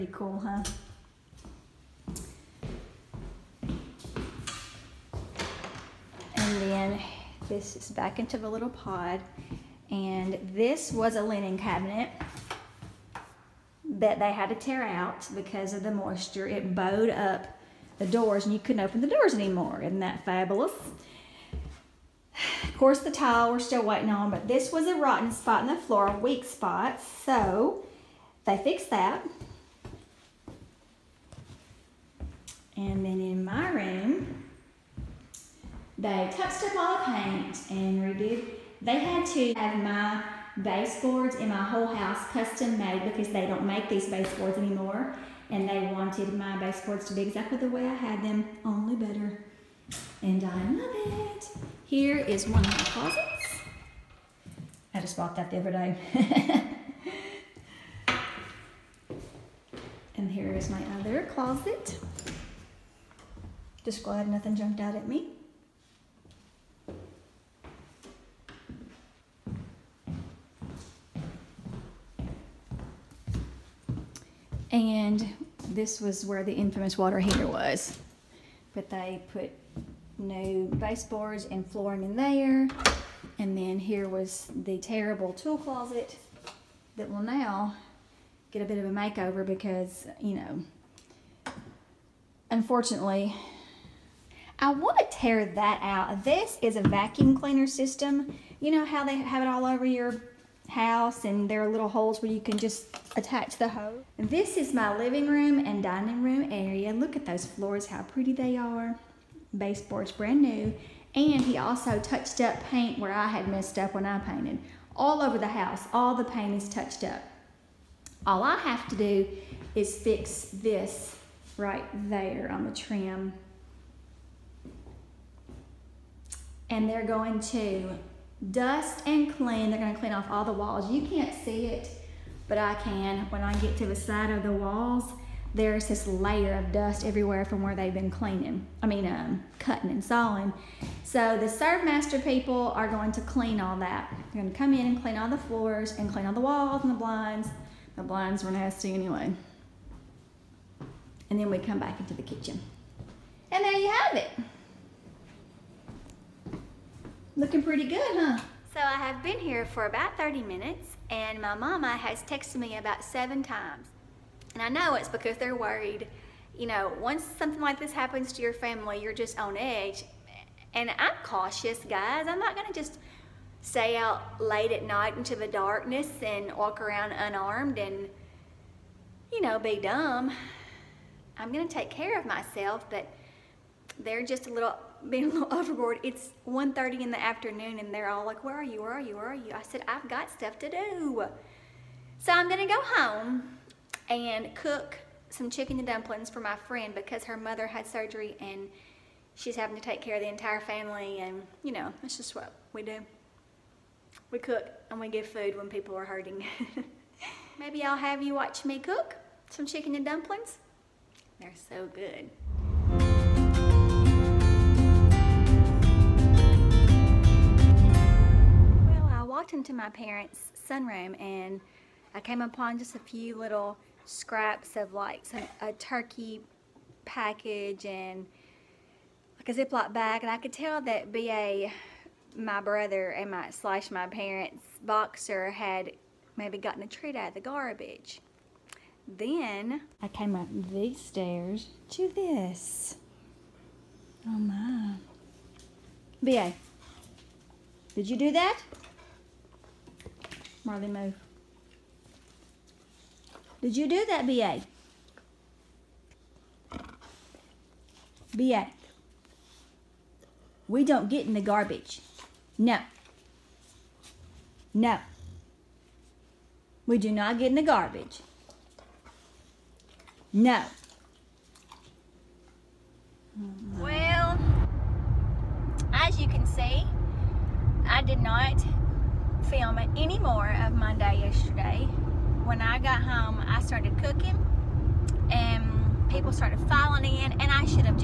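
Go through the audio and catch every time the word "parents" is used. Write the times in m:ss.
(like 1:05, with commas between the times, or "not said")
3:39, 3:54.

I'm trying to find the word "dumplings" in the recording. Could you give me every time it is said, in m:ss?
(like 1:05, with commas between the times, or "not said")
3:15, 3:30.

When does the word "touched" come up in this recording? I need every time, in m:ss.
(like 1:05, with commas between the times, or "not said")
0:36, 1:51, 1:56.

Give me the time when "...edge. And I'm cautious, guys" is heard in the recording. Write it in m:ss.
2:49.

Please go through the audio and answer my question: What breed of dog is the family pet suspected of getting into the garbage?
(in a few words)
Boxer.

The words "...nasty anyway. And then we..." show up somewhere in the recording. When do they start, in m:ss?
2:28.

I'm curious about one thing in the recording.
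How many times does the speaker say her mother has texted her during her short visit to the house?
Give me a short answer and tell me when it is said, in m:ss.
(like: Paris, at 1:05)
7, at 2:43.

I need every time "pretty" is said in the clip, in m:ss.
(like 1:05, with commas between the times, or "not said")
1:48, 2:37.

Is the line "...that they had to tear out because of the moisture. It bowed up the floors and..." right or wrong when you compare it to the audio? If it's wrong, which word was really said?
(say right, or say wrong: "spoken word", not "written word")
wrong: "doors", not "floors".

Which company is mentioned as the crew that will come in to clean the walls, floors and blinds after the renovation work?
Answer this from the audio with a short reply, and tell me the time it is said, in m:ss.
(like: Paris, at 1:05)
Serve Master, at 2:21.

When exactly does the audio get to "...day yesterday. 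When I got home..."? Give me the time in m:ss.
4:40.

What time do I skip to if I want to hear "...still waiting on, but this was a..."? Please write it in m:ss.
0:23.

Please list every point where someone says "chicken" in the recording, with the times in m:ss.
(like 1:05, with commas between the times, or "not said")
3:15, 3:29.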